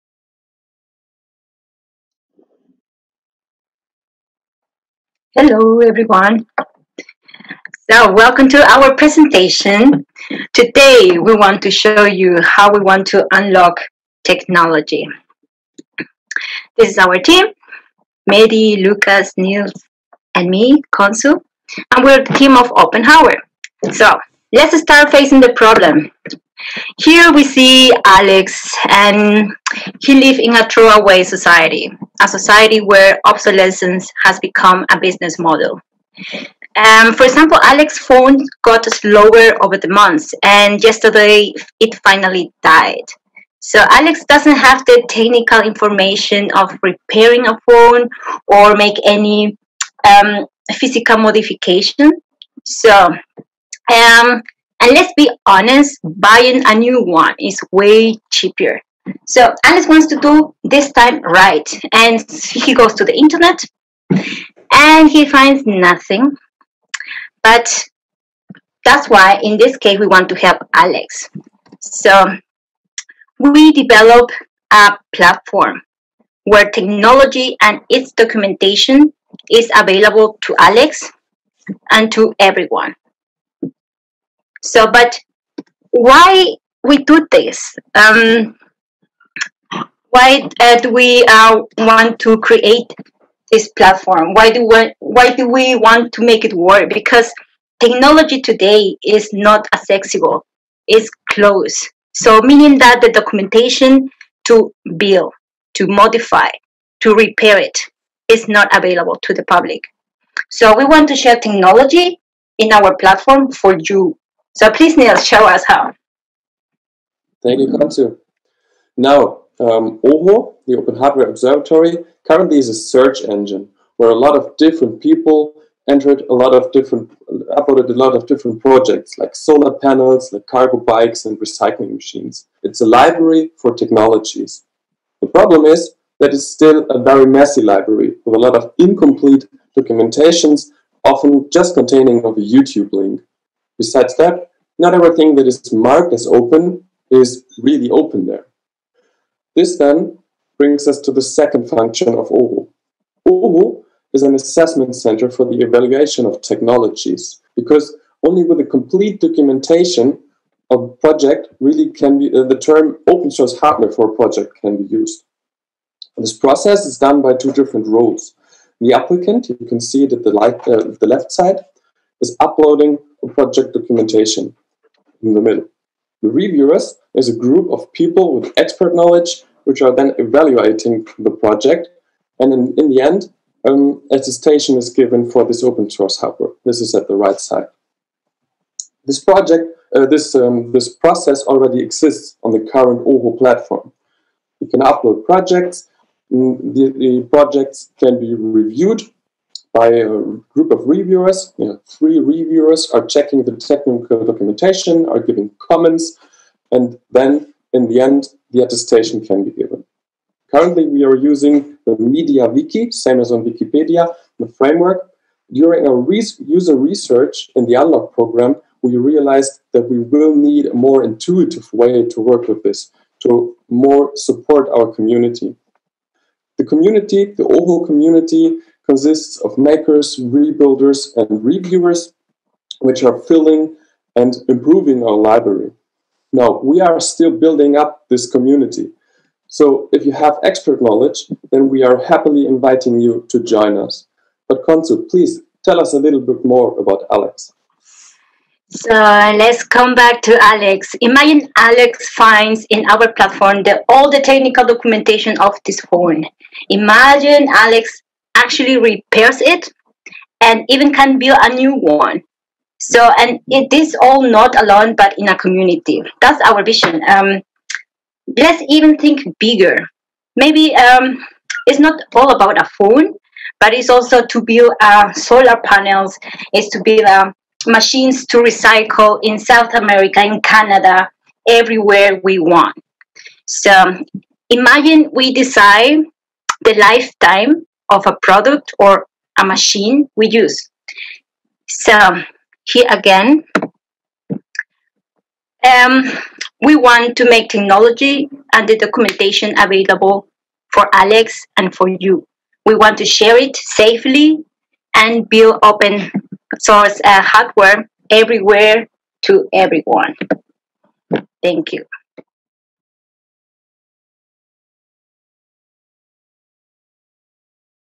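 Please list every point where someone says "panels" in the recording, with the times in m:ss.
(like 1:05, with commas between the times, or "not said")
2:09, 4:35.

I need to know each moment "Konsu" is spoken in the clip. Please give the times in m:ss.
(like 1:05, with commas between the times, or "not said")
0:20, 4:04.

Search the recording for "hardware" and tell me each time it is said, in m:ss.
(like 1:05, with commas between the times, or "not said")
2:00, 2:43, 5:07.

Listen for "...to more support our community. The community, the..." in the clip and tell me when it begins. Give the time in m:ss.
3:43.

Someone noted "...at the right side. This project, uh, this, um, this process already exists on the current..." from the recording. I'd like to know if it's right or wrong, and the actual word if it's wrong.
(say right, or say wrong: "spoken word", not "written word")
right.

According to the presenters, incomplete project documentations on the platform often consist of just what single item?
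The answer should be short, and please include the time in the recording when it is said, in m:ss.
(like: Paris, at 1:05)
a YouTube link, at 2:22.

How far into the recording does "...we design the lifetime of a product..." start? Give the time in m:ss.
4:45.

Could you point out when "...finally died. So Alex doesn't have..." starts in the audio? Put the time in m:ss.
0:42.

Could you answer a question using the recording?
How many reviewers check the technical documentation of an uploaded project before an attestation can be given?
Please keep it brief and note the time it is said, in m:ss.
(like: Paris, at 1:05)
3, at 3:21.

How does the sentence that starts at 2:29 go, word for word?
This then brings us to the second function of OHO.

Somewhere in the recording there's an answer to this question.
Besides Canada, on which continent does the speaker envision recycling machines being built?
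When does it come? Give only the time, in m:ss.
4:39.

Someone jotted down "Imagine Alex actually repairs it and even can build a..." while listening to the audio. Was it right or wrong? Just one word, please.
right.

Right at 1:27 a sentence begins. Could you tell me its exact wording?
Um, why uh, do we uh, want to create this platform?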